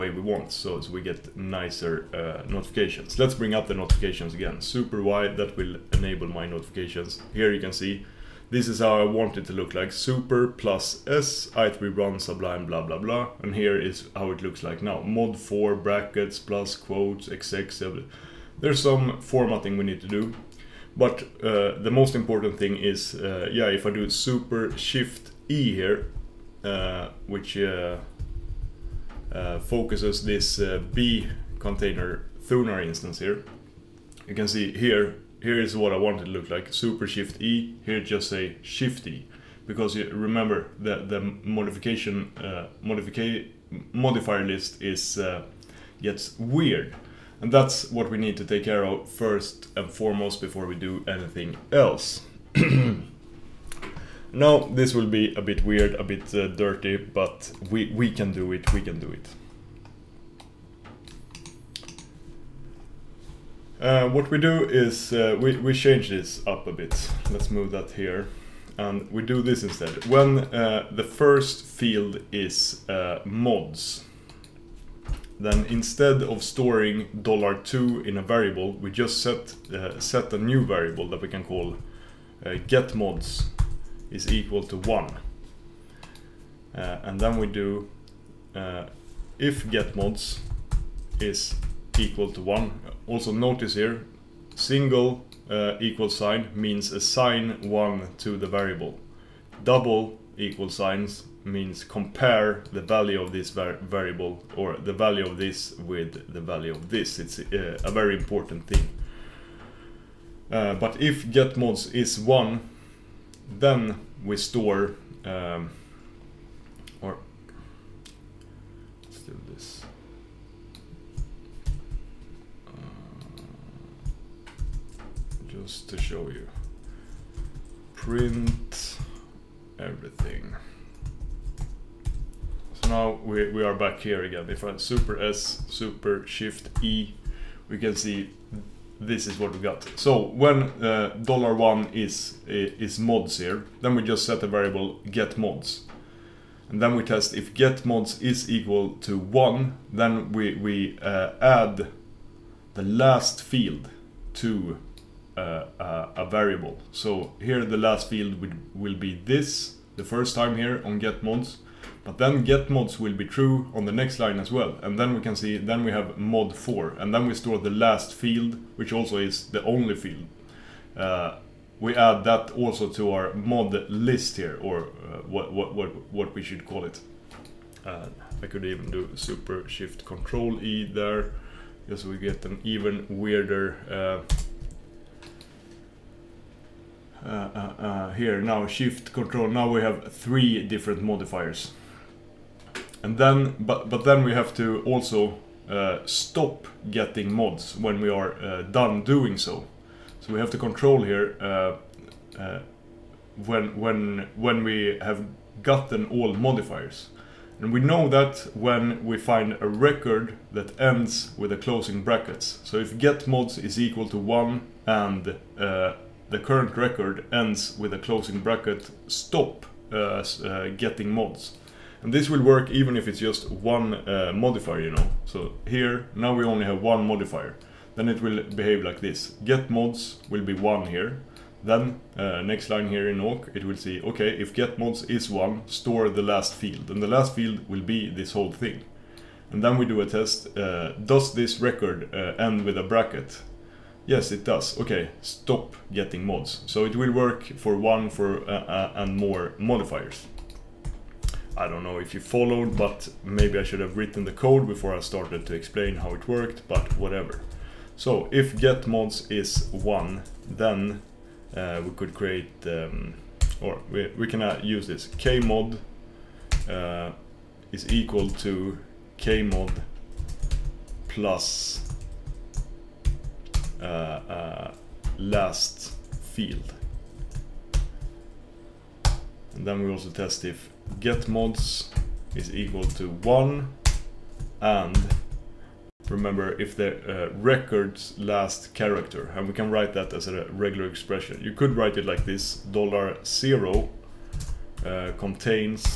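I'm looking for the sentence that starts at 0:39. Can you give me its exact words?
Because you remember that the modification uh, modifier list is uh, gets weird.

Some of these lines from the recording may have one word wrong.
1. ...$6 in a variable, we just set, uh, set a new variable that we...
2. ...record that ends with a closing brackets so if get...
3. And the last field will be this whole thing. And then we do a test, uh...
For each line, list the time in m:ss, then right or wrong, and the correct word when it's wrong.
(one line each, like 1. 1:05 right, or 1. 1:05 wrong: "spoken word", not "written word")
1. 1:17 wrong: "2", not "6"
2. 3:29 right
3. 3:56 right.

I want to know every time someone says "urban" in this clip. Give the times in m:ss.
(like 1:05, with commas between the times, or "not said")
not said.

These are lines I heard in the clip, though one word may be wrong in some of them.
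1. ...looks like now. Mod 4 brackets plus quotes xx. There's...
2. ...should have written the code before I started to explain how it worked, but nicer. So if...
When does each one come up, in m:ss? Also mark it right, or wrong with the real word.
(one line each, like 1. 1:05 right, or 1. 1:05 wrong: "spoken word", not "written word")
1. 0:14 right
2. 4:13 wrong: "whatever", not "nicer".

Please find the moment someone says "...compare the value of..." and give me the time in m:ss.
1:41.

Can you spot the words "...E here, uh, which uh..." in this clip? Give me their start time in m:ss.
0:25.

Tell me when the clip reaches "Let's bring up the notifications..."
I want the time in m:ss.
0:03.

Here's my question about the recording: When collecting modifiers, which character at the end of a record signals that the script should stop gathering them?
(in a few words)
closing bracket.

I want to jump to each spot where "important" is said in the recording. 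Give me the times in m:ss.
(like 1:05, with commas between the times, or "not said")
0:22, 1:48.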